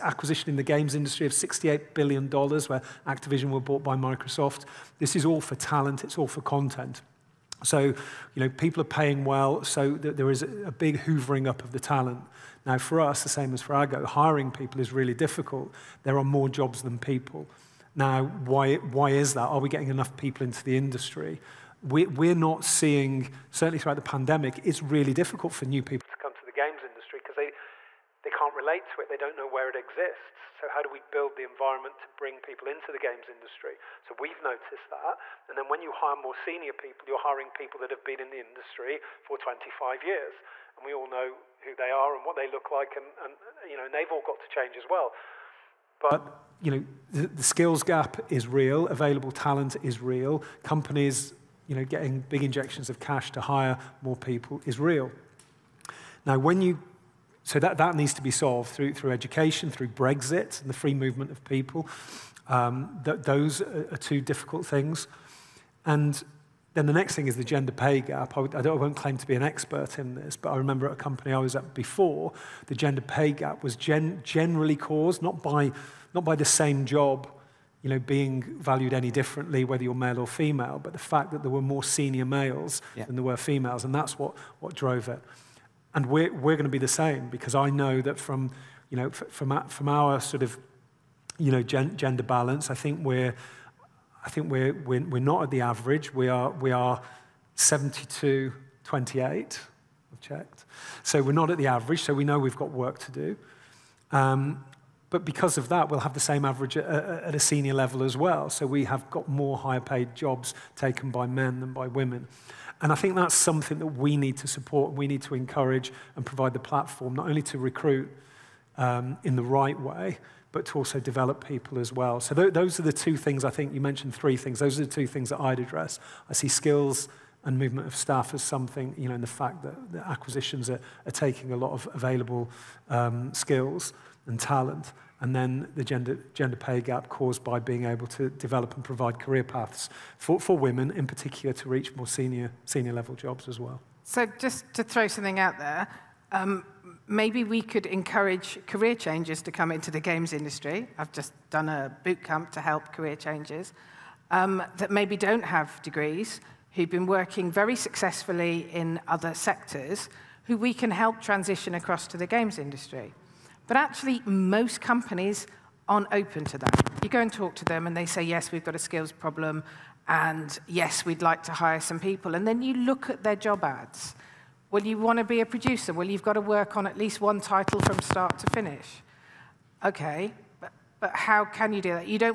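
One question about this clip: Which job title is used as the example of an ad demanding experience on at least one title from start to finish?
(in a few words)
producer.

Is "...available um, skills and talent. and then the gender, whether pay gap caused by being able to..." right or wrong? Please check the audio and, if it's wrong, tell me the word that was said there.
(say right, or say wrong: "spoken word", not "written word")
wrong: "gender", not "whether".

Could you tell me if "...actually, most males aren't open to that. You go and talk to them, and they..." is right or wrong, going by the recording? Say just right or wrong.
wrong.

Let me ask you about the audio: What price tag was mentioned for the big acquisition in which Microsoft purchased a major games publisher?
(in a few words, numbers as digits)
$68 billion.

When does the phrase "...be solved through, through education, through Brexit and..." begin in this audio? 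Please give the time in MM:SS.
00:58.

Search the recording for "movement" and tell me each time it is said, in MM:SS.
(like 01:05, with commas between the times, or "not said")
01:00, 02:07.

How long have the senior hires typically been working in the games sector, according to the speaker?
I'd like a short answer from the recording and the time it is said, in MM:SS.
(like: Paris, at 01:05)
25 years, at 00:39.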